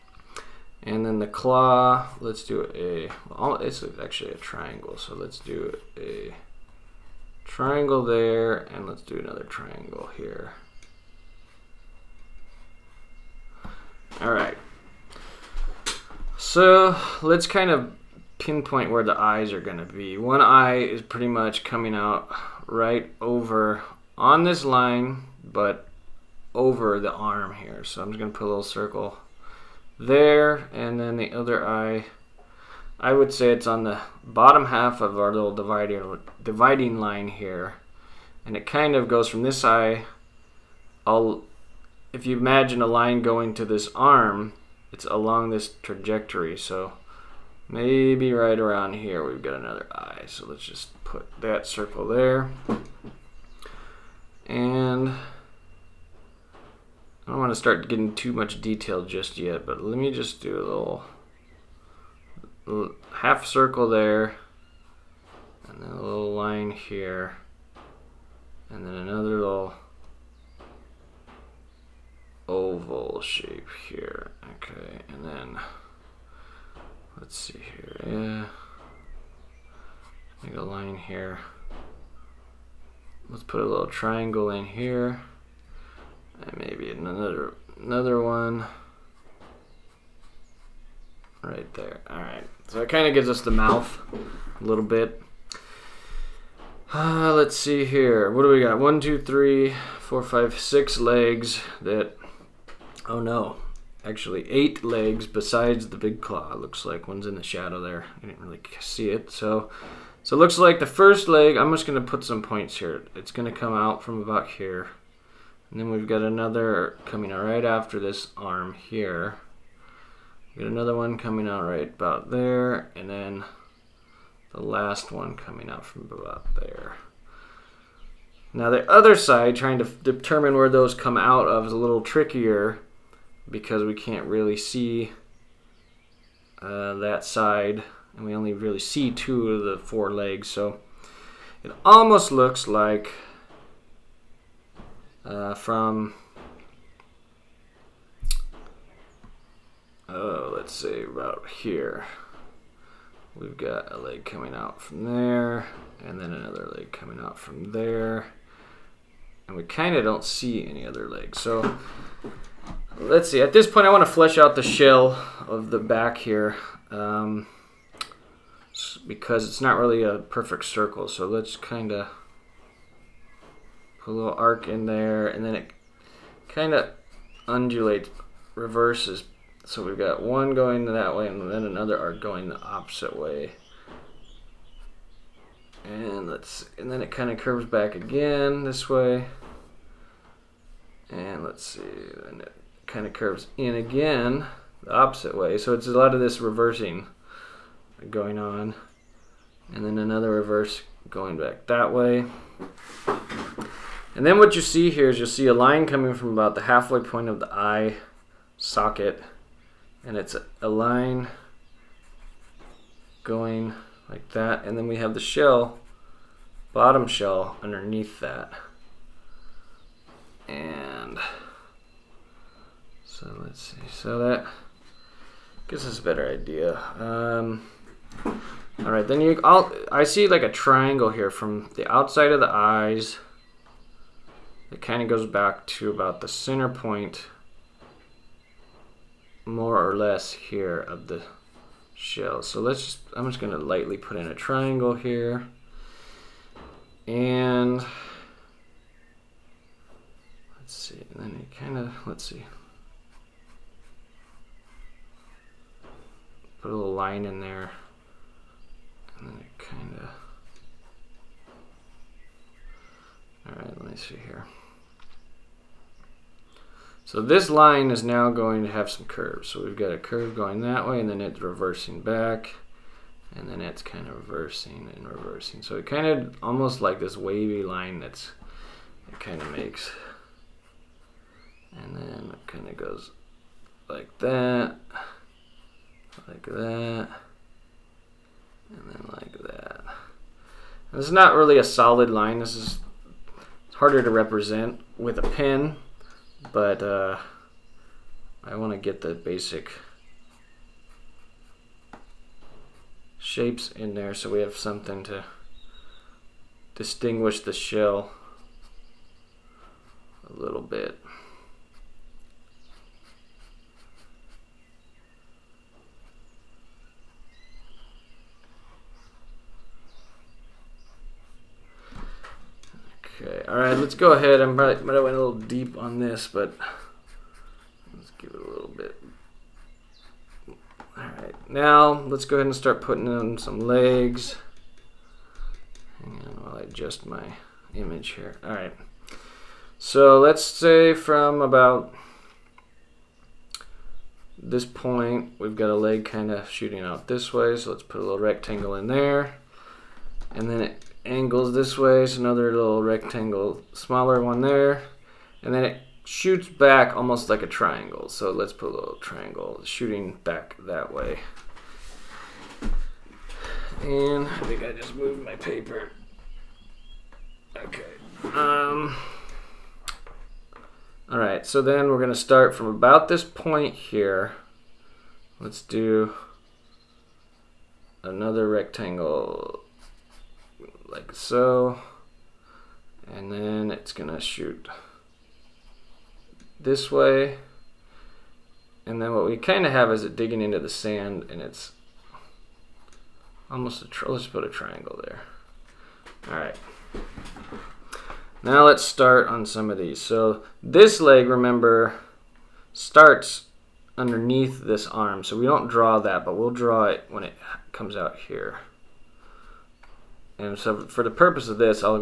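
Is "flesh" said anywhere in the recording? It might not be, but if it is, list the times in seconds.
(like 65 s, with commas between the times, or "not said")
164 s.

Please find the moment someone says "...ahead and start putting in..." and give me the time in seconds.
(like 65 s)
332 s.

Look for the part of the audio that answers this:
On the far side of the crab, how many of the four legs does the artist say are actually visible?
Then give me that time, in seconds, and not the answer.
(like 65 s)
139 s.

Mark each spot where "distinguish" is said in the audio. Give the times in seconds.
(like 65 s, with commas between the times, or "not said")
306 s.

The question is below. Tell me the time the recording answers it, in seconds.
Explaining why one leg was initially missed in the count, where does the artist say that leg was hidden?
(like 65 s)
107 s.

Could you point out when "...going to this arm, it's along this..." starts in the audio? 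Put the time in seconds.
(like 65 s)
43 s.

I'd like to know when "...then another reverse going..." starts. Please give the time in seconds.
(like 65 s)
199 s.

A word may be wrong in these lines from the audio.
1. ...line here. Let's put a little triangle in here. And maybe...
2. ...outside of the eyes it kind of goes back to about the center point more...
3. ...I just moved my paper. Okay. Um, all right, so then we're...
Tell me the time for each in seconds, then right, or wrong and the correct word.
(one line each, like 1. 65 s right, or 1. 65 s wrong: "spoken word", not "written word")
1. 80 s right
2. 231 s right
3. 364 s right.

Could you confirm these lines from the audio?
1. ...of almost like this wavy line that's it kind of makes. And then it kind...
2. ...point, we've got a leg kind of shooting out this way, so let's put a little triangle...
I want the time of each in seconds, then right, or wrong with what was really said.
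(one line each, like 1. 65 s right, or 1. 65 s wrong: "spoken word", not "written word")
1. 276 s right
2. 344 s wrong: "rectangle", not "triangle".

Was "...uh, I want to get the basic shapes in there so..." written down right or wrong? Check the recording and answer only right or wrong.
right.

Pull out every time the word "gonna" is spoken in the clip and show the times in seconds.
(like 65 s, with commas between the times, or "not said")
19 s, 28 s, 243 s, 371 s, 383 s.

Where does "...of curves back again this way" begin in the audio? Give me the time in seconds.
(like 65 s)
187 s.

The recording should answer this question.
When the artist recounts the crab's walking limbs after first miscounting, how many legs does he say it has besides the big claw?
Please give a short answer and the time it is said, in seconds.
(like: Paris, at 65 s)
8, at 104 s.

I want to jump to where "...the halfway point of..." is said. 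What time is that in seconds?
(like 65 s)
206 s.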